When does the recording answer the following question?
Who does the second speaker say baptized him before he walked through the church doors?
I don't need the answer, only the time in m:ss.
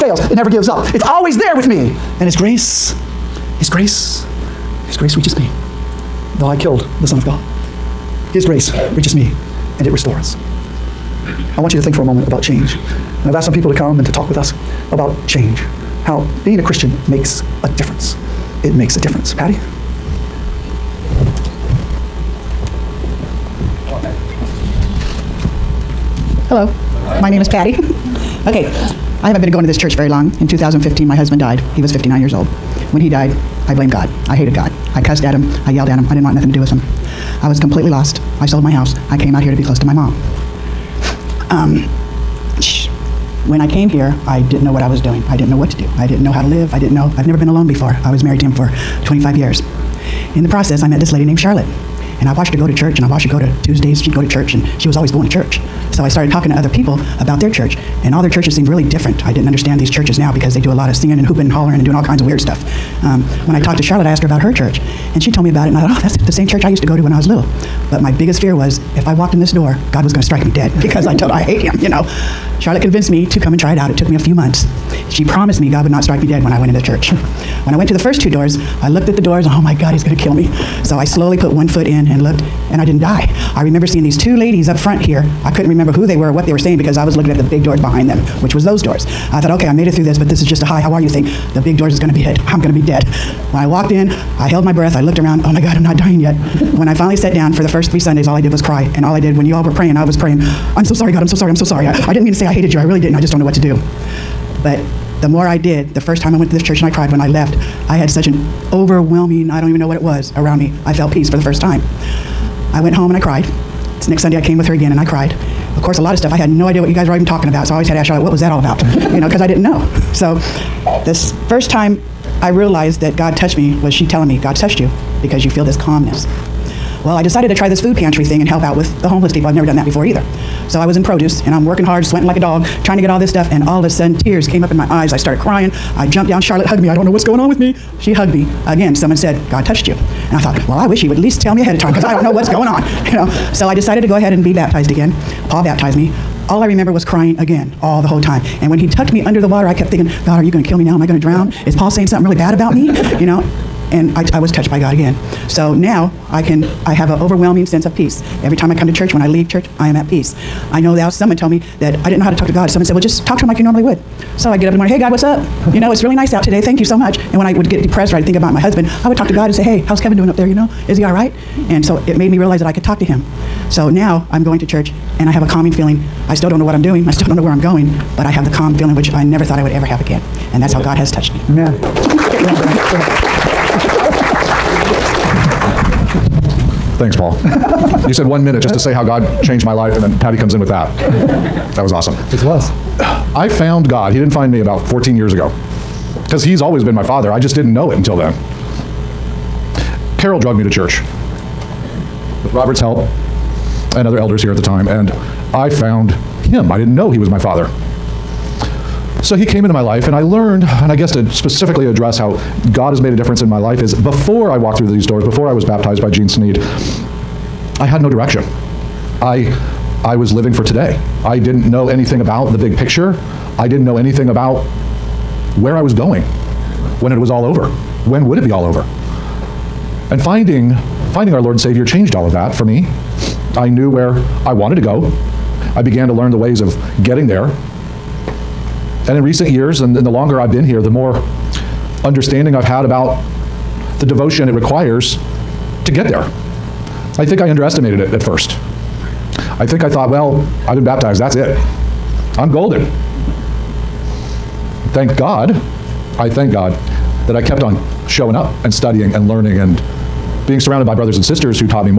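3:36.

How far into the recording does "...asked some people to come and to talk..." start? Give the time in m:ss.
0:13.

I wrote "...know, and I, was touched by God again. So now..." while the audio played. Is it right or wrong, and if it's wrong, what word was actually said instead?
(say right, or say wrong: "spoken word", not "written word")
right.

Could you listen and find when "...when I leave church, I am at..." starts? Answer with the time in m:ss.
2:39.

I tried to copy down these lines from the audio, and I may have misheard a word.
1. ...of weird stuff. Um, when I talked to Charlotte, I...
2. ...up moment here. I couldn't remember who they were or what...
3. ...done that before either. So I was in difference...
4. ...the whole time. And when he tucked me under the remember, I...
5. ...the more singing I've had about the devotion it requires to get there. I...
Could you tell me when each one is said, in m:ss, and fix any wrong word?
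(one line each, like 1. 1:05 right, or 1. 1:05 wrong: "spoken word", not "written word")
1. 1:02 right
2. 1:24 wrong: "front", not "moment"
3. 2:09 wrong: "produce", not "difference"
4. 2:28 wrong: "water", not "remember"
5. 4:00 wrong: "understanding", not "singing".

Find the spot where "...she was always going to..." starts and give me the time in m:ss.
0:54.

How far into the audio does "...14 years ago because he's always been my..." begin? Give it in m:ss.
3:14.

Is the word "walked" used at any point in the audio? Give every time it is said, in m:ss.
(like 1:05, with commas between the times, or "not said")
1:09, 1:33, 3:34.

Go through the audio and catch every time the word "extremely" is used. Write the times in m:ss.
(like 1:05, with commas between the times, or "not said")
not said.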